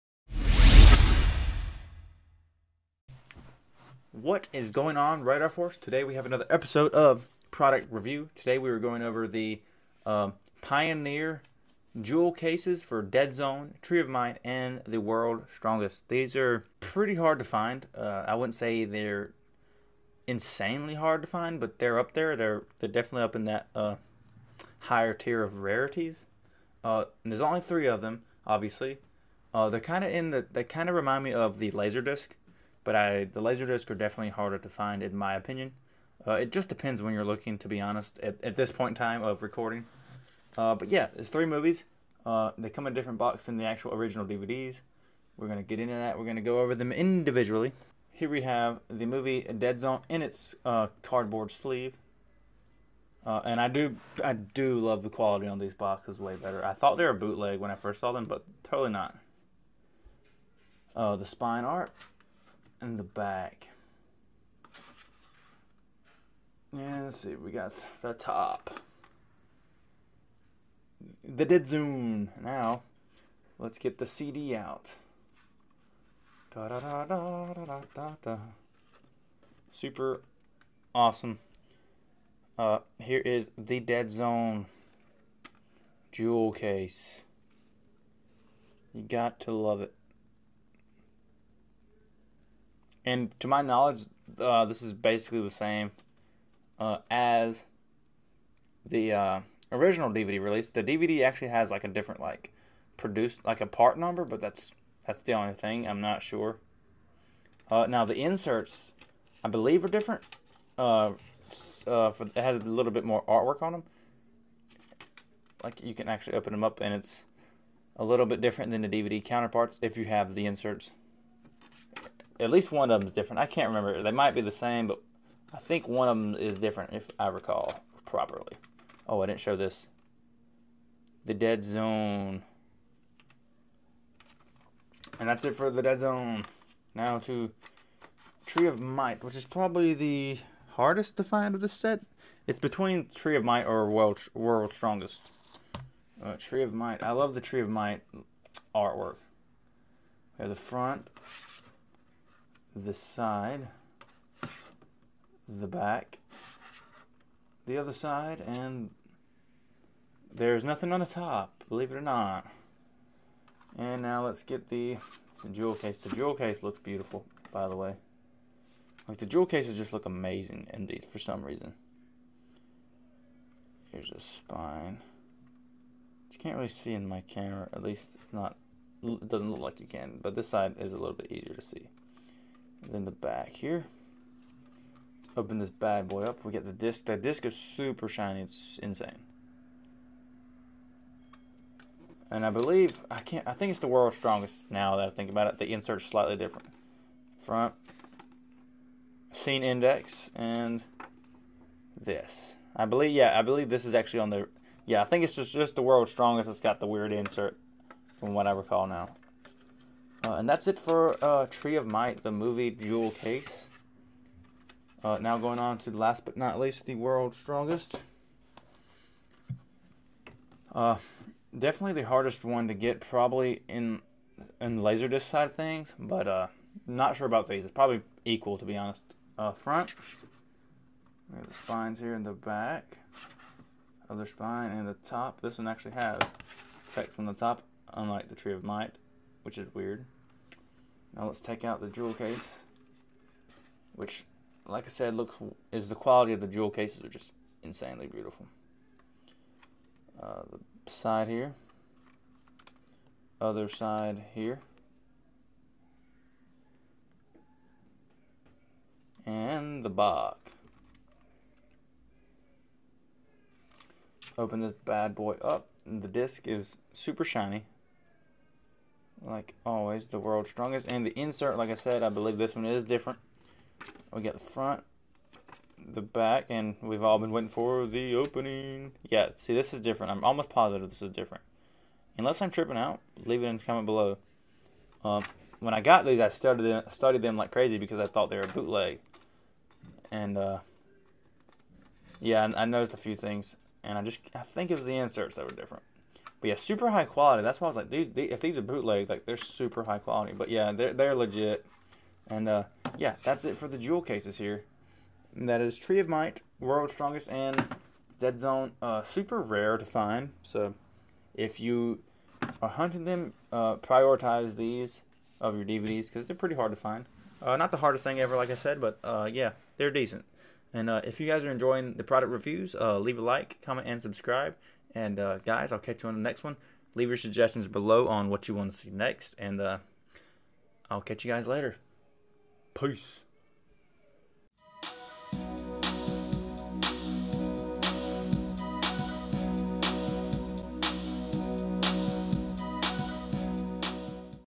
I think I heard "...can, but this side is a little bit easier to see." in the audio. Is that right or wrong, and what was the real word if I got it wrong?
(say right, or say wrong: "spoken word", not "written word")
right.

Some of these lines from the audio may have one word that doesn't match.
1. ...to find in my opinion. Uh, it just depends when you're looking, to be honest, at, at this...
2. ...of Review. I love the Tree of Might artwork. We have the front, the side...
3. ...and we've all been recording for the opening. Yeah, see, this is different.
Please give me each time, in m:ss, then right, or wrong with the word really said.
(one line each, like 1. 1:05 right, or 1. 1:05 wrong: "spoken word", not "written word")
1. 0:34 right
2. 2:26 wrong: "Might", not "Review"
3. 4:36 wrong: "waiting", not "recording".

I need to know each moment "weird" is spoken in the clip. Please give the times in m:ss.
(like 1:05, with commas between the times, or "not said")
3:26, 3:59.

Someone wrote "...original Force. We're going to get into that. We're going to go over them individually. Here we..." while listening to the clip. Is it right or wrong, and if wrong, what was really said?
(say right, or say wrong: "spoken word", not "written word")
wrong: "DVDs", not "Force".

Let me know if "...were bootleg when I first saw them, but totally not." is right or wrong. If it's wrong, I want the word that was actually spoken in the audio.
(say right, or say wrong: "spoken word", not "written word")
right.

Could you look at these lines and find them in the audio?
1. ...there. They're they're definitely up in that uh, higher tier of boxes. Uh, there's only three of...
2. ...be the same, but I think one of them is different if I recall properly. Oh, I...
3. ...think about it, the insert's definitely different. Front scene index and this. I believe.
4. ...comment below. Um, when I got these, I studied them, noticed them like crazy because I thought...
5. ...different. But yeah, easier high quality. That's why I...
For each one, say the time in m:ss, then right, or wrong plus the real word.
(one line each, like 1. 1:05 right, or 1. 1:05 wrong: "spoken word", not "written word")
1. 0:22 wrong: "rarities", not "boxes"
2. 2:04 right
3. 3:15 wrong: "slightly", not "definitely"
4. 4:43 wrong: "studied", not "noticed"
5. 4:55 wrong: "super", not "easier".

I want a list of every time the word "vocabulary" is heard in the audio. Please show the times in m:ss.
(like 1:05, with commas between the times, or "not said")
not said.